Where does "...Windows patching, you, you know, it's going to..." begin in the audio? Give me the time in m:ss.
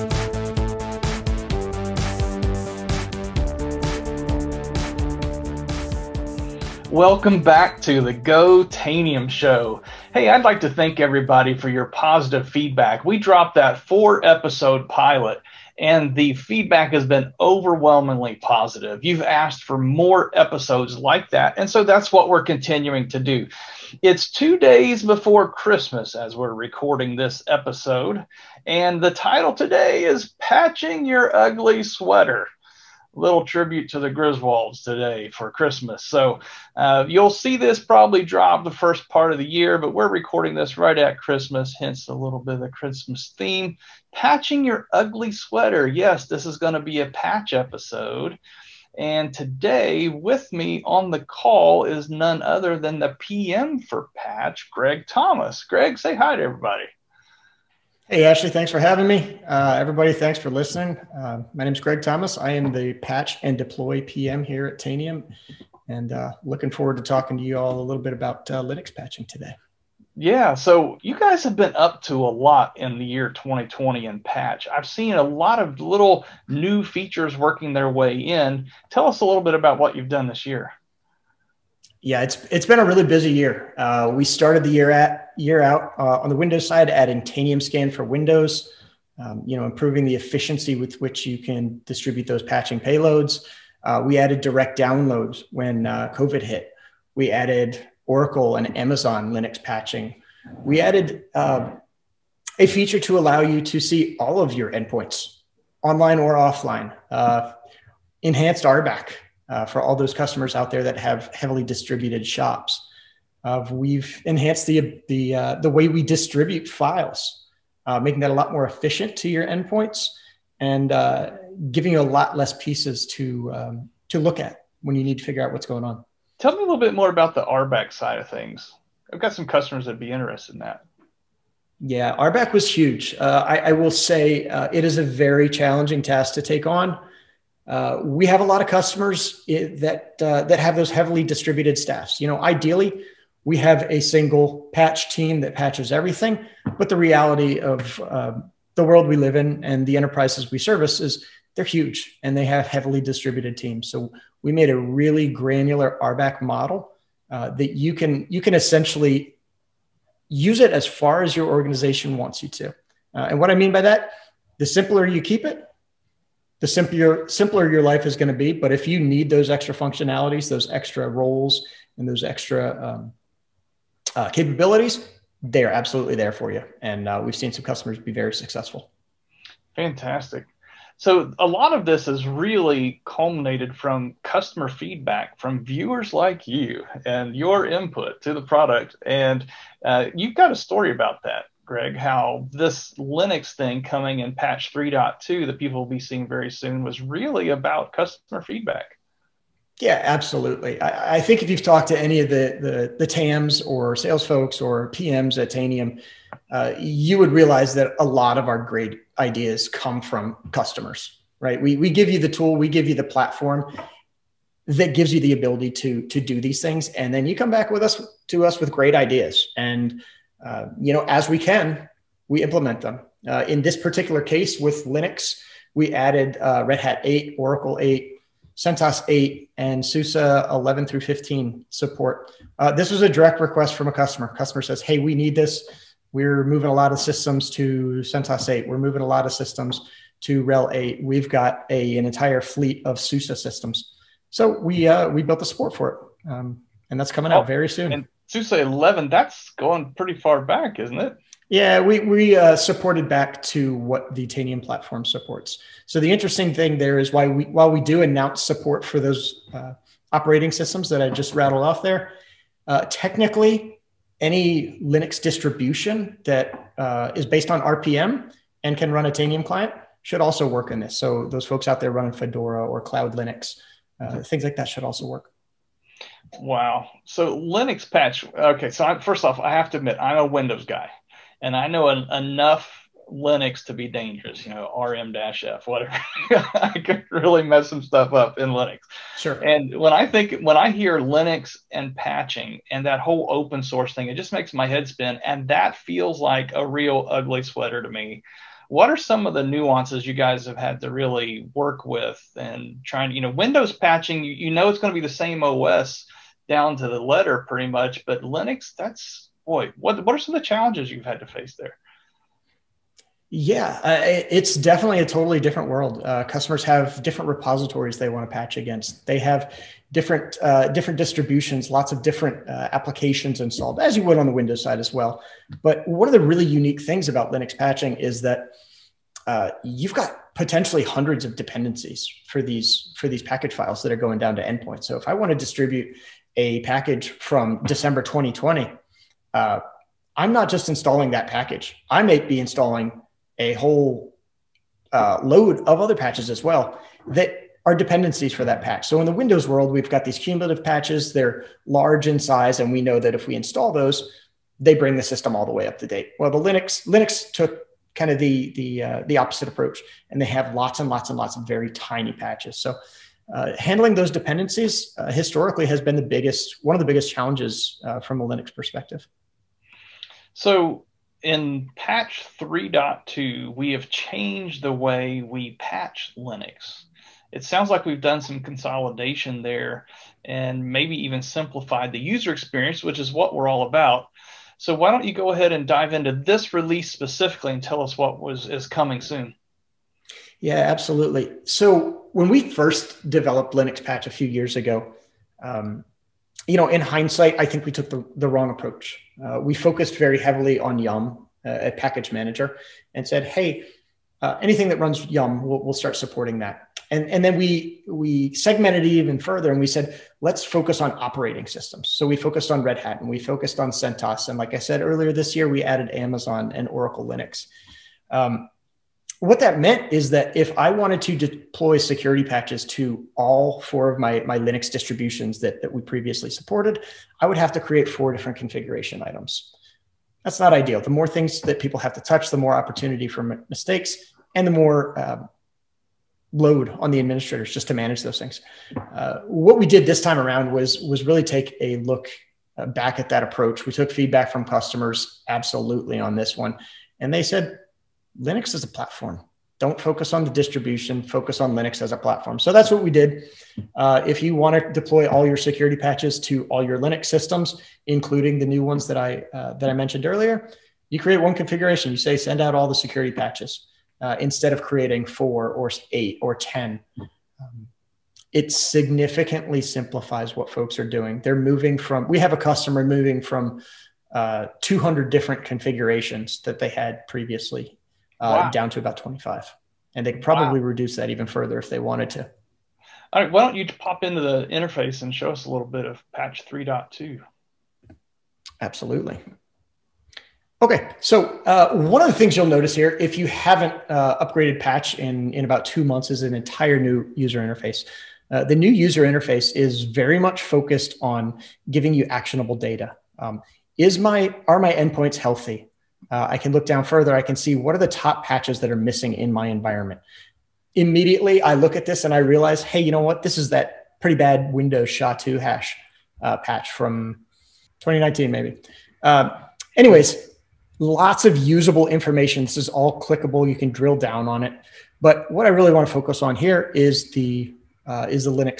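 5:03.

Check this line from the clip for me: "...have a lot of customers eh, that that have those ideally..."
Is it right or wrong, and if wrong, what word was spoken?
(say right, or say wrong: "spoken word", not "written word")
wrong: "heavily", not "ideally".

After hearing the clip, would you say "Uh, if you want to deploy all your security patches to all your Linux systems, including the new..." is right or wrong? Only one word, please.
right.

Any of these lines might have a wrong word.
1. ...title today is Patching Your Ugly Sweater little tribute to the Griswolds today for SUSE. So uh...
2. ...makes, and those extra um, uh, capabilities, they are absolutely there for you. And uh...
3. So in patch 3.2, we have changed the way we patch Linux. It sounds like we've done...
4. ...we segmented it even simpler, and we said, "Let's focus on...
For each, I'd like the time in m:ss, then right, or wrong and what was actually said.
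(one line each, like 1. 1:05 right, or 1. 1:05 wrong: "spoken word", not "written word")
1. 0:29 wrong: "Christmas", not "SUSE"
2. 2:51 wrong: "roles", not "makes"
3. 6:10 right
4. 6:47 wrong: "further", not "simpler".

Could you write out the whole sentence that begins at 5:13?
Yeah, uh, it's definitely a totally different world.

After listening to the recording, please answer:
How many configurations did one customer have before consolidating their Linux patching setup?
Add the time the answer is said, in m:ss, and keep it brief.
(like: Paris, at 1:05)
200, at 7:54.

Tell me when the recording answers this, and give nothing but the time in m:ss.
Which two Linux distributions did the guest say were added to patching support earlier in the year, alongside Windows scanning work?
1:38.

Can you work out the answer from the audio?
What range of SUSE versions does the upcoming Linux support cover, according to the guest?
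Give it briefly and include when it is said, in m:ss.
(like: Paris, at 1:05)
SUSE 11 through 15, at 3:49.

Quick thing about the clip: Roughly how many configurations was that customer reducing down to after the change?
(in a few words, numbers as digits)
25.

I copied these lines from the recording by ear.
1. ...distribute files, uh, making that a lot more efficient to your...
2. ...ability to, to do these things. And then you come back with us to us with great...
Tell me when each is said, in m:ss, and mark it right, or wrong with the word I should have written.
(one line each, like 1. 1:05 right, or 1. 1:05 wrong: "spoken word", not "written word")
1. 1:56 right
2. 3:35 right.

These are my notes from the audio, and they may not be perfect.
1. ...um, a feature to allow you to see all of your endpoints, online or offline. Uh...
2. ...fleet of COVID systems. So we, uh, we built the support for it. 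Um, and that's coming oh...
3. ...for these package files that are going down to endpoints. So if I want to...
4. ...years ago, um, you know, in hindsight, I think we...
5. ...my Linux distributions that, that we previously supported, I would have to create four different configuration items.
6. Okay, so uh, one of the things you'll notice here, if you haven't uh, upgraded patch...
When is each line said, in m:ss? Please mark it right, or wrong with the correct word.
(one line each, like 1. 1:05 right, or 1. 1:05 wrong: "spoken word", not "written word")
1. 1:41 right
2. 4:02 wrong: "SUSE", not "COVID"
3. 5:32 right
4. 6:34 right
5. 7:04 right
6. 8:10 right.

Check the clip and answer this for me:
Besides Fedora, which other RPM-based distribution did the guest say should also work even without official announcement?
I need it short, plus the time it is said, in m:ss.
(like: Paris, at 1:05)
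Cloud Linux, at 4:32.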